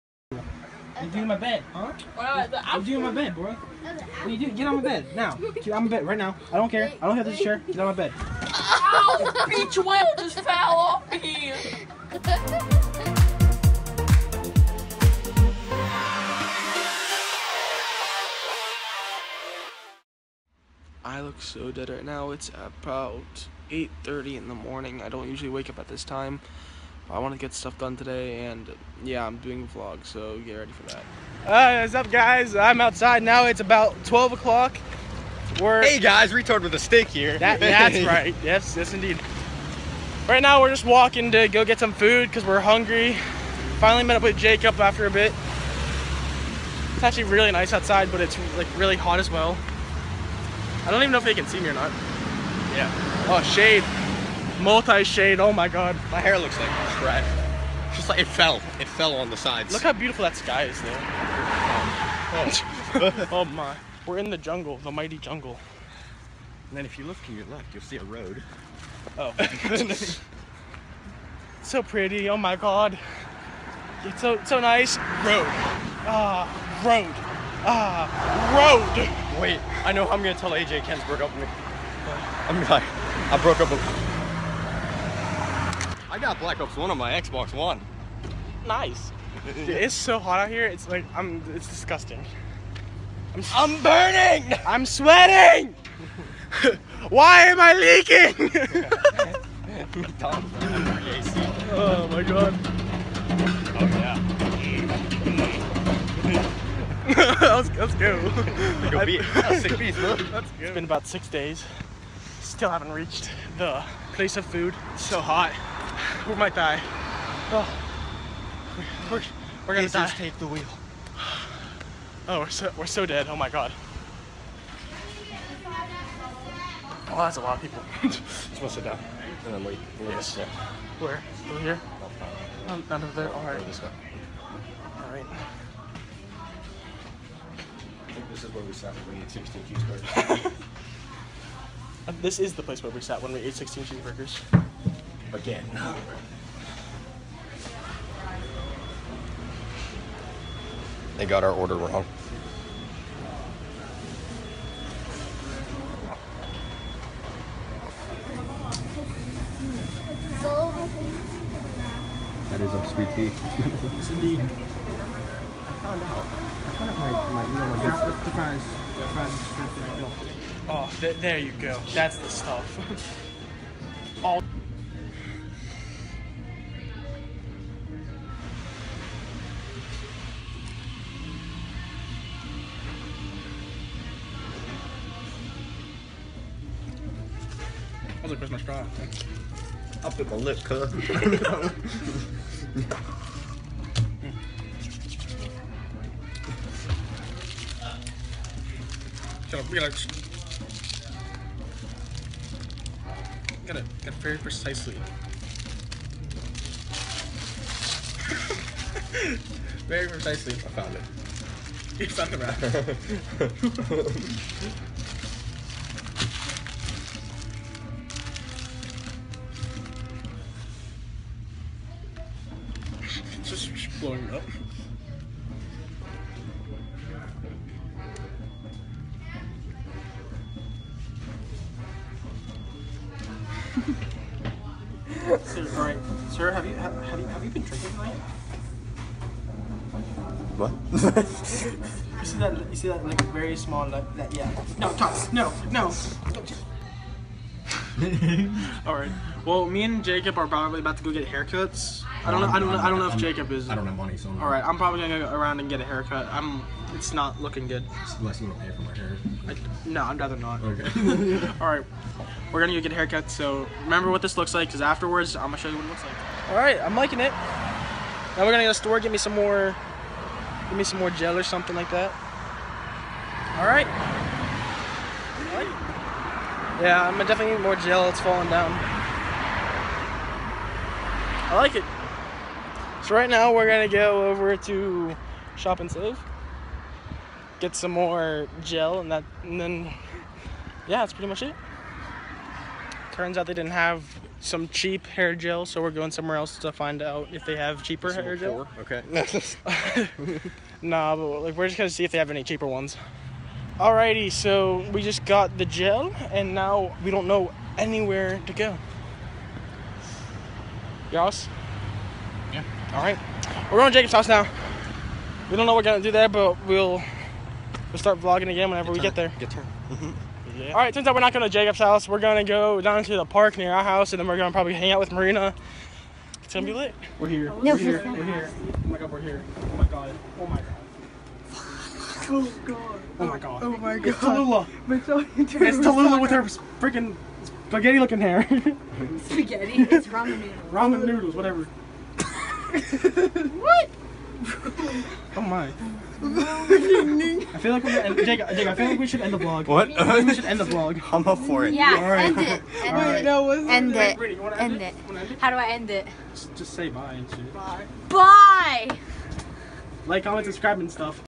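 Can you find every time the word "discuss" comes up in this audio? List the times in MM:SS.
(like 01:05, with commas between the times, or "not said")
not said.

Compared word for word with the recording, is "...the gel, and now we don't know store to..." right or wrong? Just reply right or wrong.
wrong.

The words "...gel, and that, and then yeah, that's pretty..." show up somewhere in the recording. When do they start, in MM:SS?
04:48.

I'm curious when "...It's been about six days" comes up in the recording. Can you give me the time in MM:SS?
01:49.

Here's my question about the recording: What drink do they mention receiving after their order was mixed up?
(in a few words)
sweet tea.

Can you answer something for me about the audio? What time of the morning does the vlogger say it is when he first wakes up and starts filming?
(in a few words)
8:30.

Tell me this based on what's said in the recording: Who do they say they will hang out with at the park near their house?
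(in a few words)
Marina.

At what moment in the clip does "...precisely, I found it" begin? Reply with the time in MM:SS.
03:30.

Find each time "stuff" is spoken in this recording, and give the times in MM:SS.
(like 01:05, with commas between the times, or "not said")
00:27, 02:52, 06:00.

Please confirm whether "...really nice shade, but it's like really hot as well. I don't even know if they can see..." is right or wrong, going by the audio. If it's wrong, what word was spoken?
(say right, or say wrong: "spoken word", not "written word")
wrong: "outside", not "shade".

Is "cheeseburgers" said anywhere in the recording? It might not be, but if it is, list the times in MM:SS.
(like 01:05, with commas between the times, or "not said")
02:19, 02:23.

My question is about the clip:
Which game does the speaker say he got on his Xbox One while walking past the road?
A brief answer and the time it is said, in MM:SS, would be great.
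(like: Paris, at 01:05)
Black Ops 1, at 01:26.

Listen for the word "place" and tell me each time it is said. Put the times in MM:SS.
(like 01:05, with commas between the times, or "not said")
01:54, 02:22.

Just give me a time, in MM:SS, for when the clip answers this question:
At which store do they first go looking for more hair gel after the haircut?
04:45.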